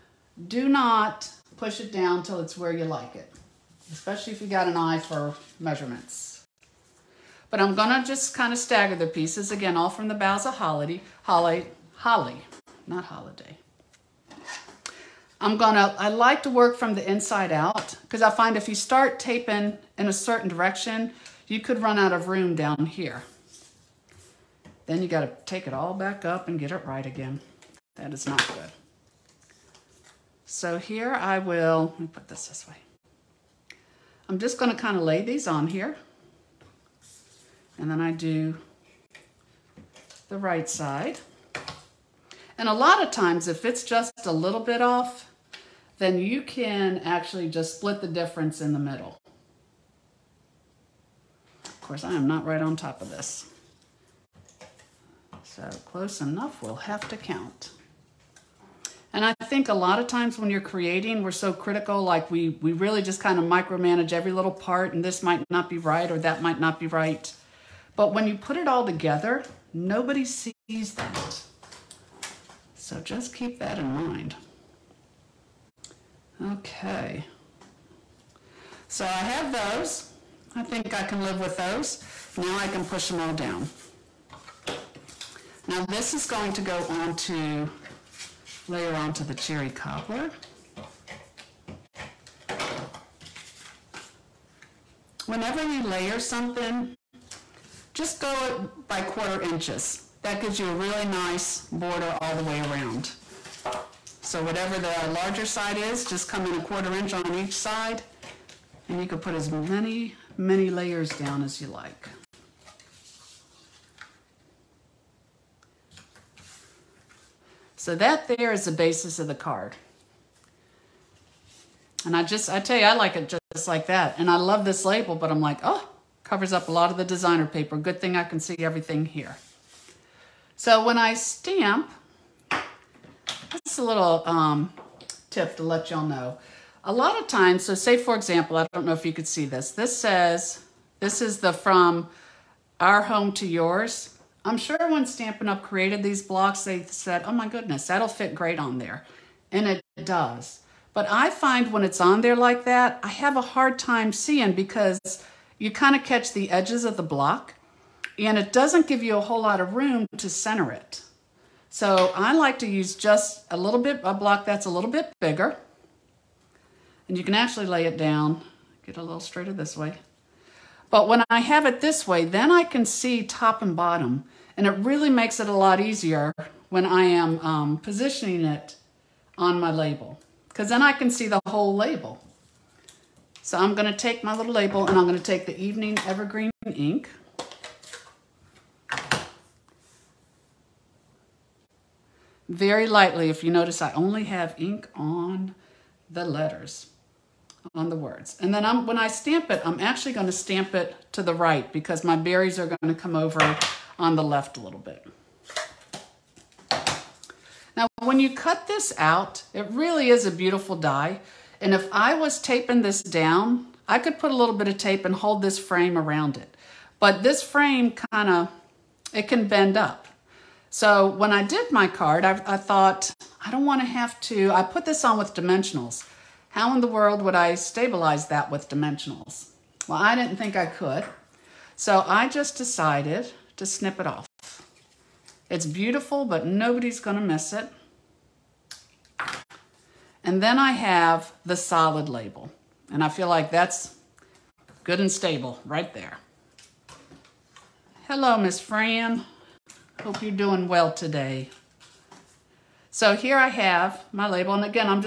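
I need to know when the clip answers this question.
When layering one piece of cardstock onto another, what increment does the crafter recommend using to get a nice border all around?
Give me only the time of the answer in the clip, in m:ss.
1:39.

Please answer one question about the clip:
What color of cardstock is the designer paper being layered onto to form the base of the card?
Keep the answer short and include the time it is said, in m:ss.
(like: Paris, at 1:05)
cherry cobbler, at 1:29.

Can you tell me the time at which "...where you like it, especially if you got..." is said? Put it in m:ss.
0:02.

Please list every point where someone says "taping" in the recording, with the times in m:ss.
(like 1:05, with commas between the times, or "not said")
0:19, 3:32.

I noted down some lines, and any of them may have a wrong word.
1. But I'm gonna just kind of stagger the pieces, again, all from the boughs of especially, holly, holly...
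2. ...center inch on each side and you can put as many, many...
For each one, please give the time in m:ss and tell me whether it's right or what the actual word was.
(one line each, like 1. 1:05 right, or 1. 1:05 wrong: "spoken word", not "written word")
1. 0:07 wrong: "holly", not "especially"
2. 1:46 wrong: "quarter", not "center".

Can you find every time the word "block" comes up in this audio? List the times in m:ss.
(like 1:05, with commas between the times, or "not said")
2:26, 2:37, 2:44.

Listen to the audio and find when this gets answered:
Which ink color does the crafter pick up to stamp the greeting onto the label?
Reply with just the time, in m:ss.
3:05.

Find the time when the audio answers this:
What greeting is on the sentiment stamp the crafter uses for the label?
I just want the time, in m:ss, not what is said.
2:21.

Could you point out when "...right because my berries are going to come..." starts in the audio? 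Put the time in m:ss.
3:21.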